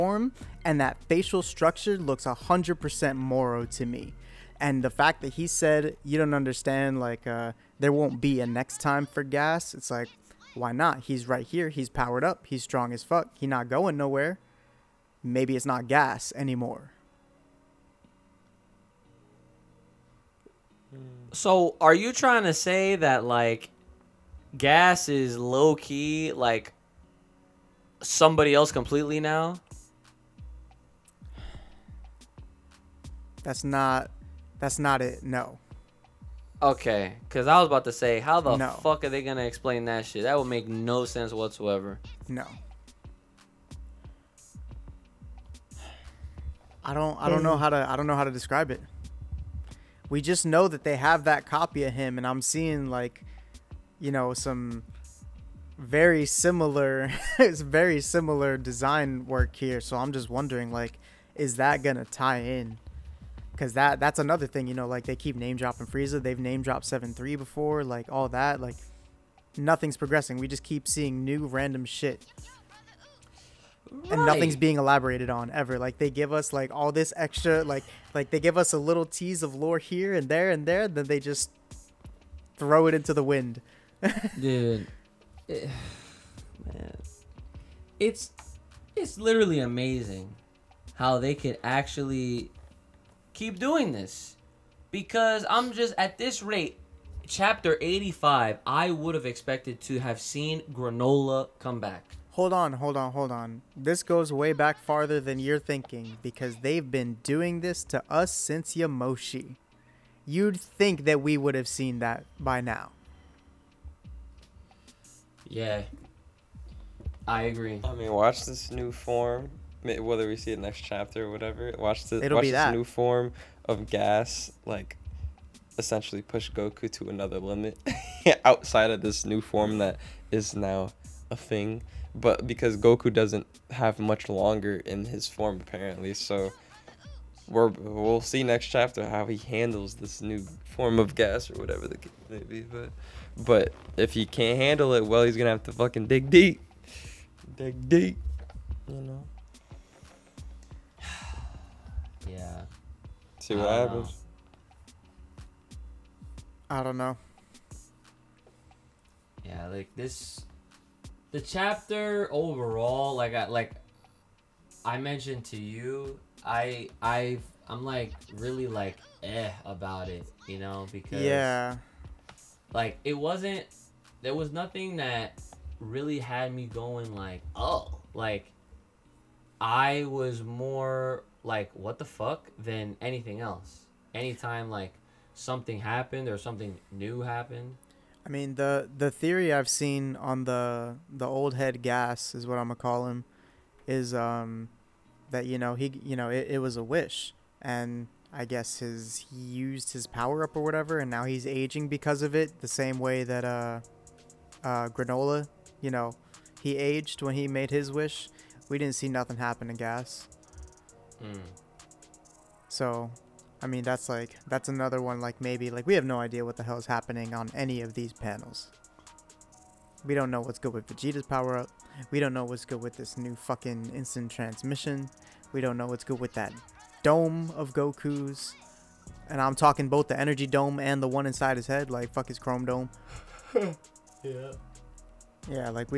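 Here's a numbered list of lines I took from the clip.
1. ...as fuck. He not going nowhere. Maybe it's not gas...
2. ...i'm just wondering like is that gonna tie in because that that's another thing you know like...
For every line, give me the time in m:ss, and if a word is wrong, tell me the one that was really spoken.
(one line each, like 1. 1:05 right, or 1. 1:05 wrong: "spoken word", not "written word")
1. 0:12 right
2. 0:59 right.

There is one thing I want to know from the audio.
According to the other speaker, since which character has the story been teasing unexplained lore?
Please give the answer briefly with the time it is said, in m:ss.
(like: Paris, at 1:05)
Yamoshi, at 1:48.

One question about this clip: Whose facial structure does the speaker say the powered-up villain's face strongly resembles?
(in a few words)
Moro.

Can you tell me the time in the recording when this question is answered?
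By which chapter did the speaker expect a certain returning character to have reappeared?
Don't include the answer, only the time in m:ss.
1:37.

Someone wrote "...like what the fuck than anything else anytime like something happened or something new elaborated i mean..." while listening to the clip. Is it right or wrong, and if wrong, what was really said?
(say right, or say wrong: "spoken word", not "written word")
wrong: "happened", not "elaborated".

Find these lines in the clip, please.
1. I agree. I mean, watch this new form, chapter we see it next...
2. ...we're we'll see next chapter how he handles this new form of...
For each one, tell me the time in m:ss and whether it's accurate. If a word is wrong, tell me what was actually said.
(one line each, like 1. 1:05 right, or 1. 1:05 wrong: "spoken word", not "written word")
1. 1:57 wrong: "whether", not "chapter"
2. 2:17 right.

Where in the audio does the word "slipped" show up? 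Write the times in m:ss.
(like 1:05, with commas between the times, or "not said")
not said.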